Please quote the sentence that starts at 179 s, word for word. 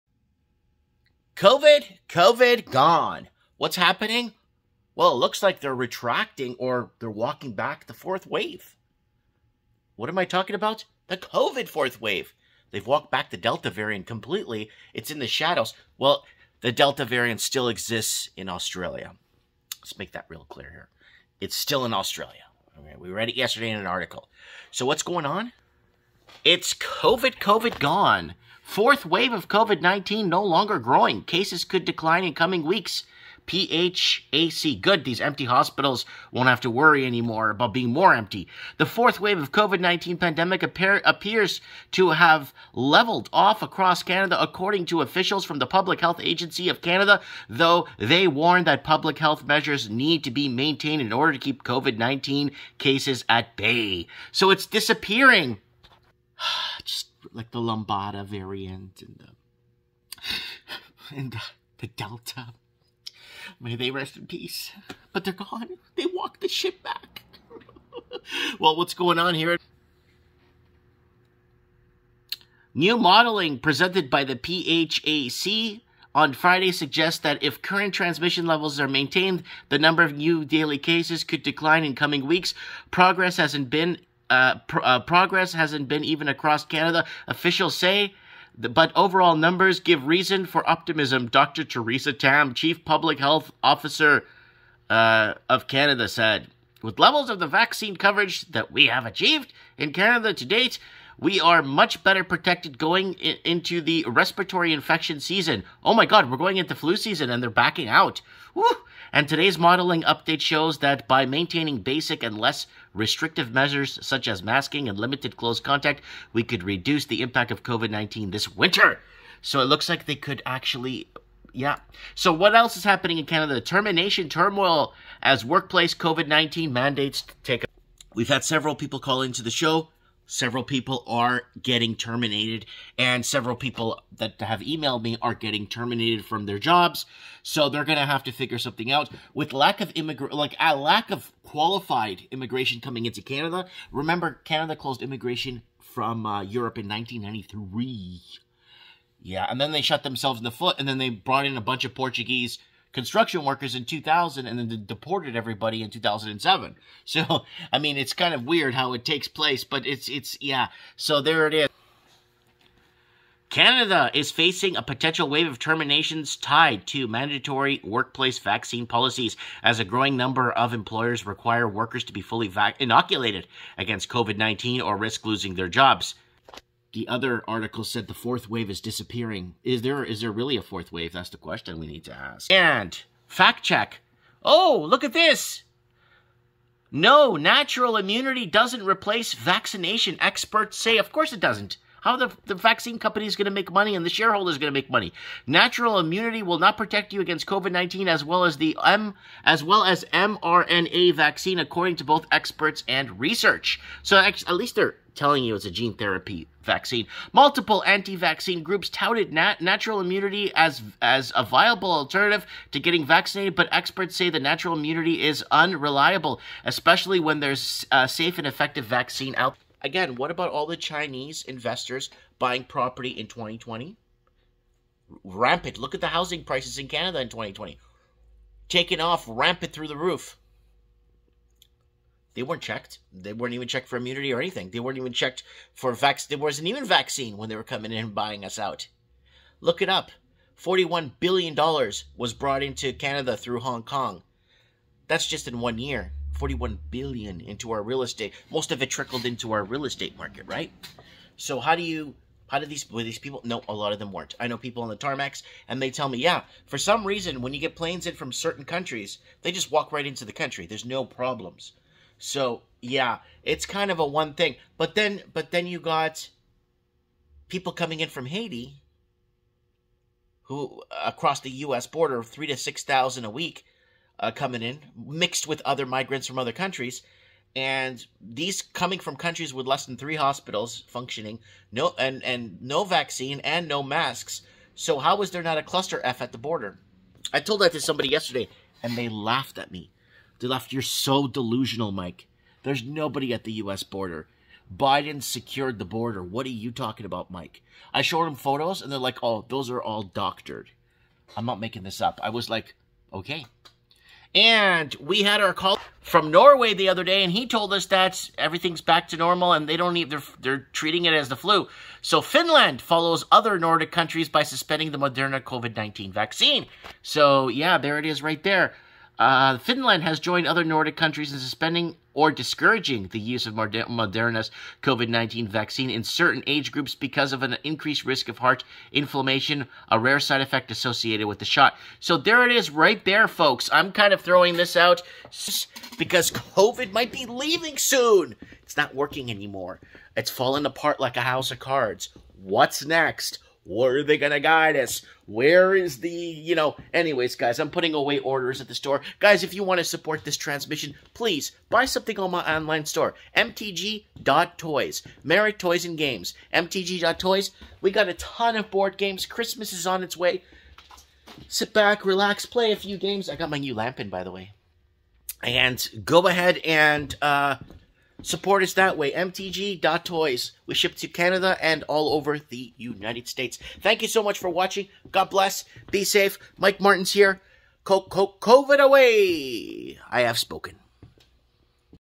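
Is there is there really a fourth wave?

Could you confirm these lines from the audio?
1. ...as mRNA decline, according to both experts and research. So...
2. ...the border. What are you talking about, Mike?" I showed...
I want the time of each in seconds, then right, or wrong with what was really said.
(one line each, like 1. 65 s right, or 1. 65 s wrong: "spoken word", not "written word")
1. 199 s wrong: "vaccine", not "decline"
2. 295 s right.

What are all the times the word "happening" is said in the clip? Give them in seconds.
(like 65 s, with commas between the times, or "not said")
3 s, 122 s.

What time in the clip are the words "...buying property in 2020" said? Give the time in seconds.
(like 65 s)
222 s.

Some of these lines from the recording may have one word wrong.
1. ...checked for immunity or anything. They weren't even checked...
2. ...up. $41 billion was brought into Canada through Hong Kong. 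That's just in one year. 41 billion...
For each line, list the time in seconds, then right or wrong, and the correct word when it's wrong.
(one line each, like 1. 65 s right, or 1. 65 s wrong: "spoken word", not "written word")
1. 233 s right
2. 239 s right.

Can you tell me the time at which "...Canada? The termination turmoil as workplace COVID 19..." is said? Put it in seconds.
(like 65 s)
123 s.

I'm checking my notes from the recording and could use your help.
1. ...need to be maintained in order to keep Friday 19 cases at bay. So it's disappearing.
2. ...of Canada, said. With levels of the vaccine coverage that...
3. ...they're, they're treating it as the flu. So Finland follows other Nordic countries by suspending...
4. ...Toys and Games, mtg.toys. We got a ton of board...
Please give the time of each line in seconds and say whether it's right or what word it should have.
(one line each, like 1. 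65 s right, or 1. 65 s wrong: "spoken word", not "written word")
1. 49 s wrong: "COVID", not "Friday"
2. 95 s right
3. 310 s right
4. 355 s right.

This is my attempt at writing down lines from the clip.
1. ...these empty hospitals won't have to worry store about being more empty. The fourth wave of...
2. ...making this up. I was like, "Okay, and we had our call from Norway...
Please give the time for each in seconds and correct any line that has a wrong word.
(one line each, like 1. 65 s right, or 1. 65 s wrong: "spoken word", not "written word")
1. 35 s wrong: "anymore", not "store"
2. 301 s right.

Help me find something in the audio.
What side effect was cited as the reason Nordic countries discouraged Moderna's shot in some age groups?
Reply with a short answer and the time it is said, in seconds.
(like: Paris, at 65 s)
Heart inflammation, at 328 s.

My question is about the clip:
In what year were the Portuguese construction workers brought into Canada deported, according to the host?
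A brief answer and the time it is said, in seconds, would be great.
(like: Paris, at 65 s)
2007, at 155 s.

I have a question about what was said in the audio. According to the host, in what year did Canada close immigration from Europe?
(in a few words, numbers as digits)
1993.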